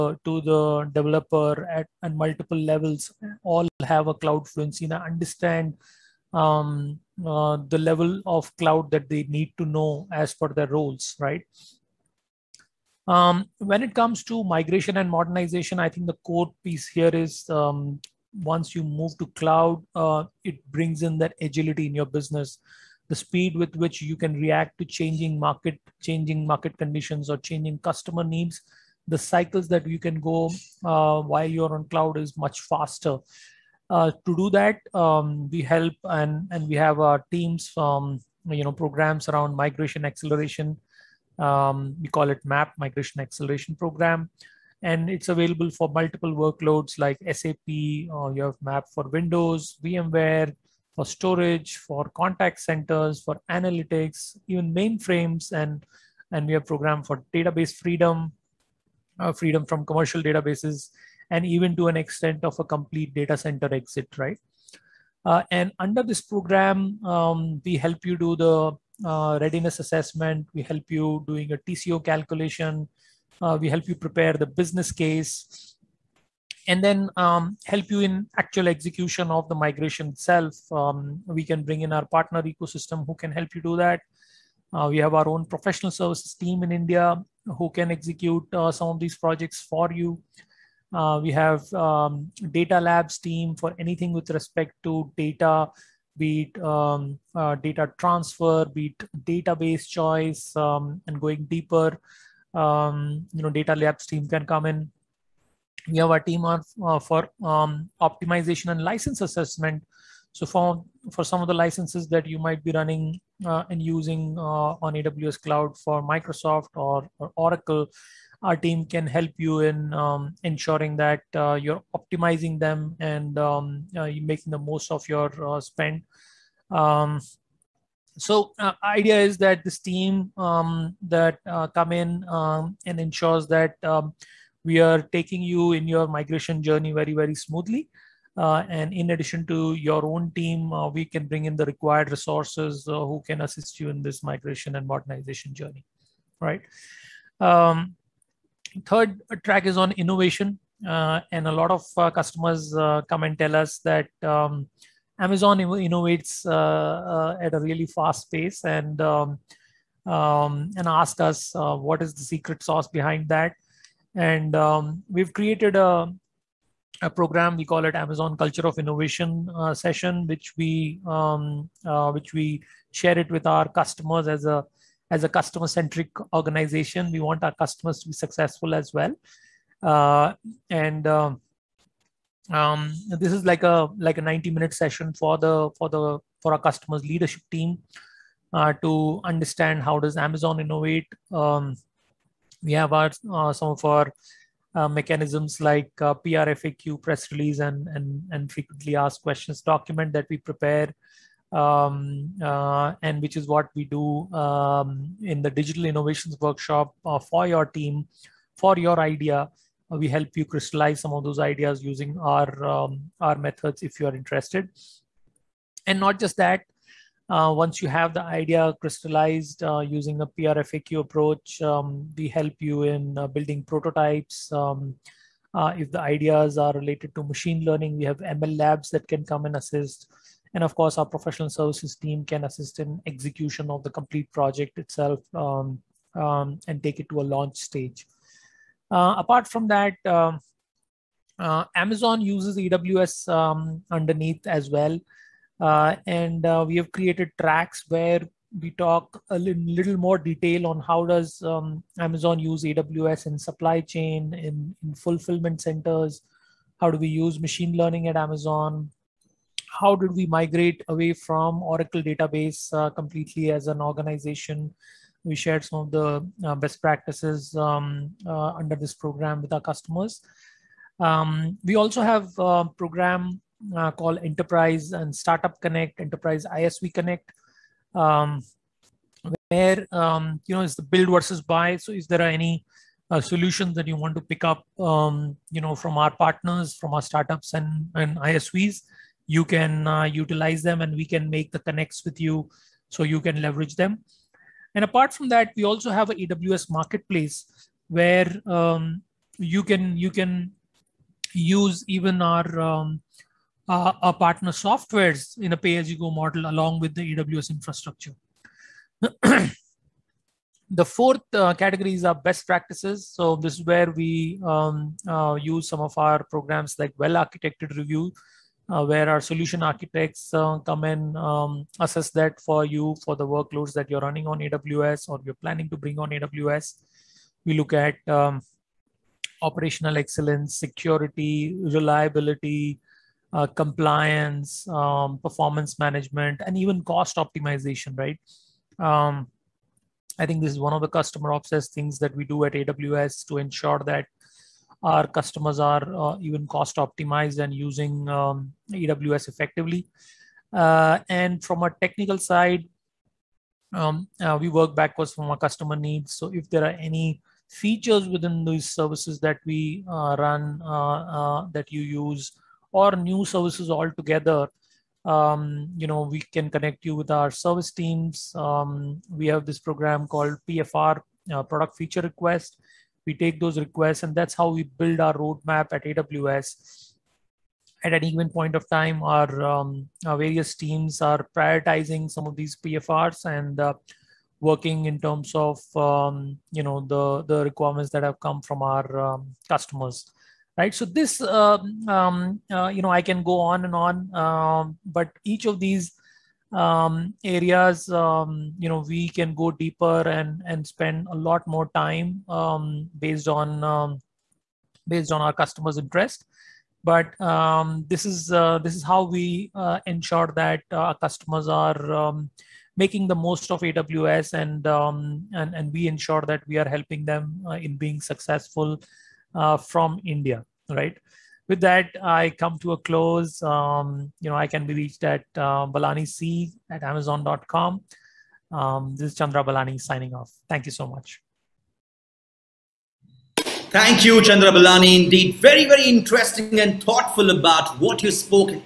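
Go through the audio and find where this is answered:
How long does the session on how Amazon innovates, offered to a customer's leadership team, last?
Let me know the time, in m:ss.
3:04.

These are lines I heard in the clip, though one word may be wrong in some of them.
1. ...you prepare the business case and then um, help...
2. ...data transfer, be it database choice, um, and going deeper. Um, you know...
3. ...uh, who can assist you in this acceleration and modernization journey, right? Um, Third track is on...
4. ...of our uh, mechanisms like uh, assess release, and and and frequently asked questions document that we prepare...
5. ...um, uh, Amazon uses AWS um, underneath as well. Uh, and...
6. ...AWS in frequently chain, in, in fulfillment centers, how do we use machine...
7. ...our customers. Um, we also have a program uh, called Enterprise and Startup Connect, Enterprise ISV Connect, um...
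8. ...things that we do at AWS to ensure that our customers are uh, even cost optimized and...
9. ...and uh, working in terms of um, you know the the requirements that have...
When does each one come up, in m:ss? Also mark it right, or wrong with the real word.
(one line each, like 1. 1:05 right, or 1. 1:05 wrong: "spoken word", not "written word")
1. 1:13 right
2. 1:37 right
3. 2:22 wrong: "migration", not "acceleration"
4. 3:13 wrong: "press", not "assess"
5. 4:00 right
6. 4:12 wrong: "supply", not "frequently"
7. 4:29 right
8. 5:41 right
9. 6:23 right.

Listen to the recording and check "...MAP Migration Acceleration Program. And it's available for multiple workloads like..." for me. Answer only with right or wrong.
right.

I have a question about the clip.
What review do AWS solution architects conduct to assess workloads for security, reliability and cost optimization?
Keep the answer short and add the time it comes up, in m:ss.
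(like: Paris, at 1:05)
Well Architected Review, at 5:16.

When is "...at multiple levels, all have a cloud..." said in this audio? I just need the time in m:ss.
0:02.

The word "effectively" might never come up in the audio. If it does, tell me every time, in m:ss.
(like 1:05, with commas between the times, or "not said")
5:49.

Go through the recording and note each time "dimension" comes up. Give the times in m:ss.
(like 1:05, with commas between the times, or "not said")
not said.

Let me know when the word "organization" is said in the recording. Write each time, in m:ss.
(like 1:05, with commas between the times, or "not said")
2:56, 4:23.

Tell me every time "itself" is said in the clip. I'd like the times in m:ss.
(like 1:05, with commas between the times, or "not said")
1:20, 3:54.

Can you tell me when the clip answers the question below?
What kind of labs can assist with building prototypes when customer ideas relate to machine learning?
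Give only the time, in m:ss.
3:48.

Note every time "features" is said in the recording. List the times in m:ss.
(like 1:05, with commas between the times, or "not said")
5:57, 6:11.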